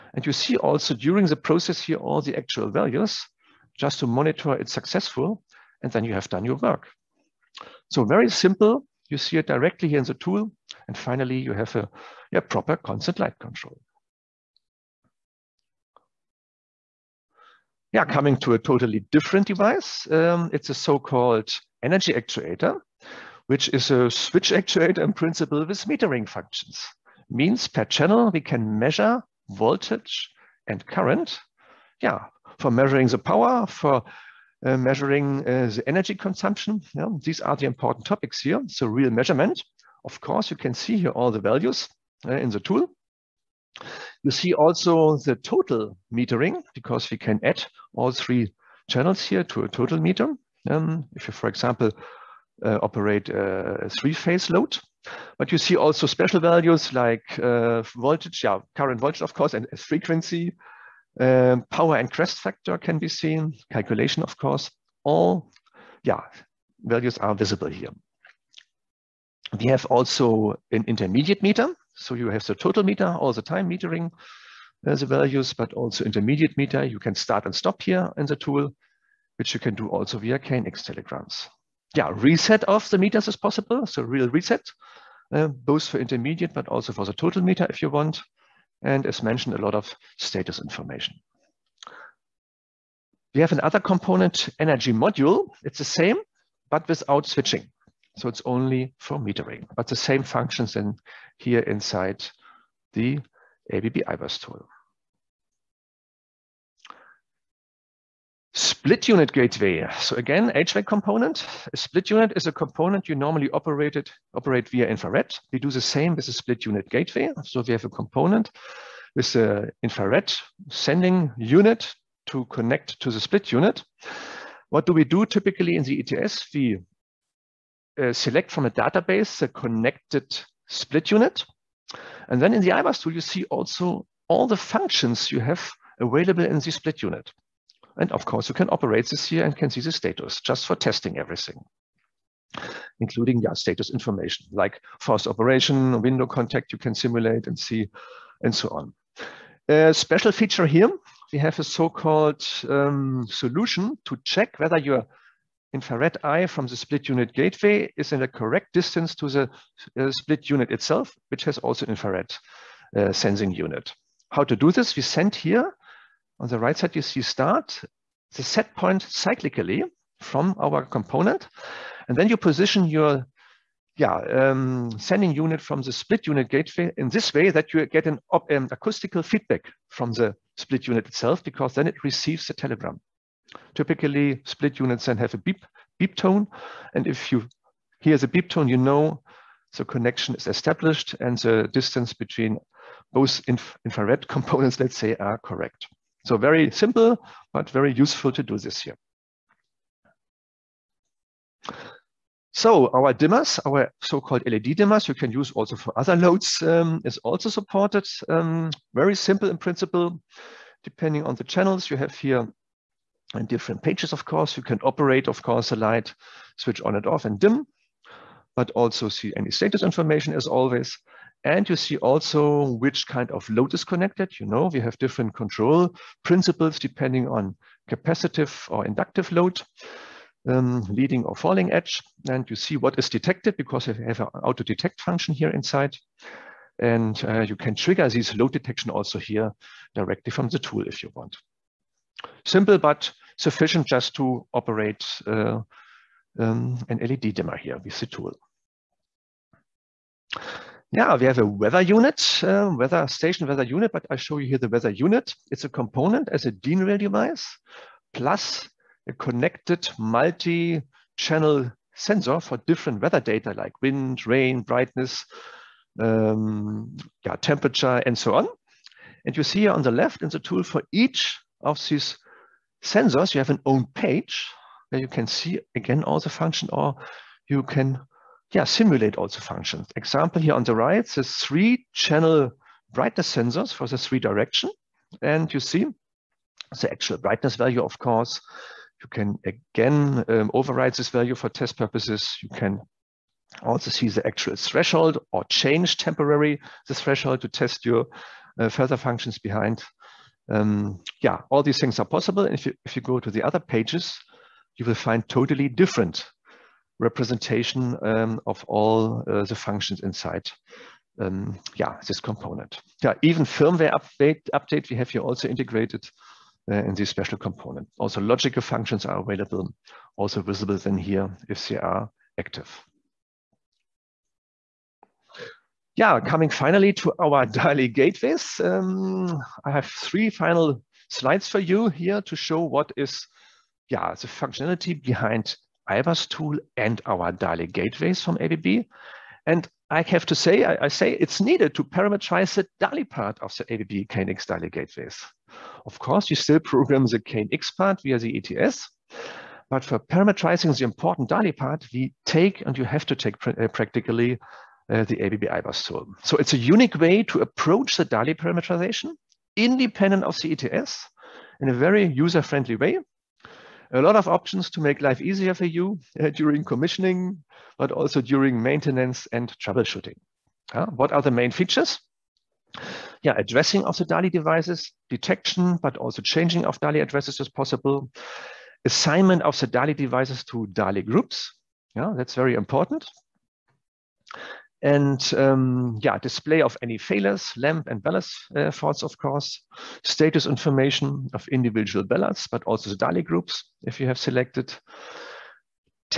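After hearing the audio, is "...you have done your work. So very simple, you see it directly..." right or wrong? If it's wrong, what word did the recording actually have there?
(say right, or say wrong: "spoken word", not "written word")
right.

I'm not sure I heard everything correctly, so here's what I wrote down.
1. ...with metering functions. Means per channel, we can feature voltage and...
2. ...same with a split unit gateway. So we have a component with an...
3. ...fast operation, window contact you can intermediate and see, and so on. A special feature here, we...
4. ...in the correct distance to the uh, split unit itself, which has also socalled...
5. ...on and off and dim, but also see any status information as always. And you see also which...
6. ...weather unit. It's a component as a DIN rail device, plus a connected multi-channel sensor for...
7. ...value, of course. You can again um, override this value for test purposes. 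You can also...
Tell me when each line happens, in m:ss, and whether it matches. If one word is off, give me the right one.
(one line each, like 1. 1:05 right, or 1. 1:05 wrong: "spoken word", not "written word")
1. 0:25 wrong: "measure", not "feature"
2. 1:55 right
3. 2:25 wrong: "simulate", not "intermediate"
4. 2:38 wrong: "infrared", not "socalled"
5. 3:36 right
6. 4:14 right
7. 4:47 right.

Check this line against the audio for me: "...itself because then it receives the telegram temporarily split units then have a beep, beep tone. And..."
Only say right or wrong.
wrong.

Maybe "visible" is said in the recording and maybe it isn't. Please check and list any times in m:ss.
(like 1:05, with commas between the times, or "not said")
1:07, 5:20.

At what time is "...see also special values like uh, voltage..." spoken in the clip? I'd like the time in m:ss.
0:55.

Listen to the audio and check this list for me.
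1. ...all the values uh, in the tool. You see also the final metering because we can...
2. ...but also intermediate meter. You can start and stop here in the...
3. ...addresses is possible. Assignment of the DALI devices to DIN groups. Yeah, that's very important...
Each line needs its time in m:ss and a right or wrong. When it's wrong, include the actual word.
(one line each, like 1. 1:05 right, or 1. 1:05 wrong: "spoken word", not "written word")
1. 0:41 wrong: "total", not "final"
2. 1:15 right
3. 6:17 wrong: "DALI", not "DIN".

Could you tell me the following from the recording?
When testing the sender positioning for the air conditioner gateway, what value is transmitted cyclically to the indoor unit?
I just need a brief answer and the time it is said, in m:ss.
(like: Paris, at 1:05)
The set point, at 2:48.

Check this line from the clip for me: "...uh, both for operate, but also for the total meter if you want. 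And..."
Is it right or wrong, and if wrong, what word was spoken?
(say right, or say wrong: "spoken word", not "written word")
wrong: "intermediate", not "operate".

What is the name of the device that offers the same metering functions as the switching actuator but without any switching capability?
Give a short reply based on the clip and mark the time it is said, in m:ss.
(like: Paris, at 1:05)
Energy module, at 1:34.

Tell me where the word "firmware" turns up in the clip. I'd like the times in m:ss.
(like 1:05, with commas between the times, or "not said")
5:13.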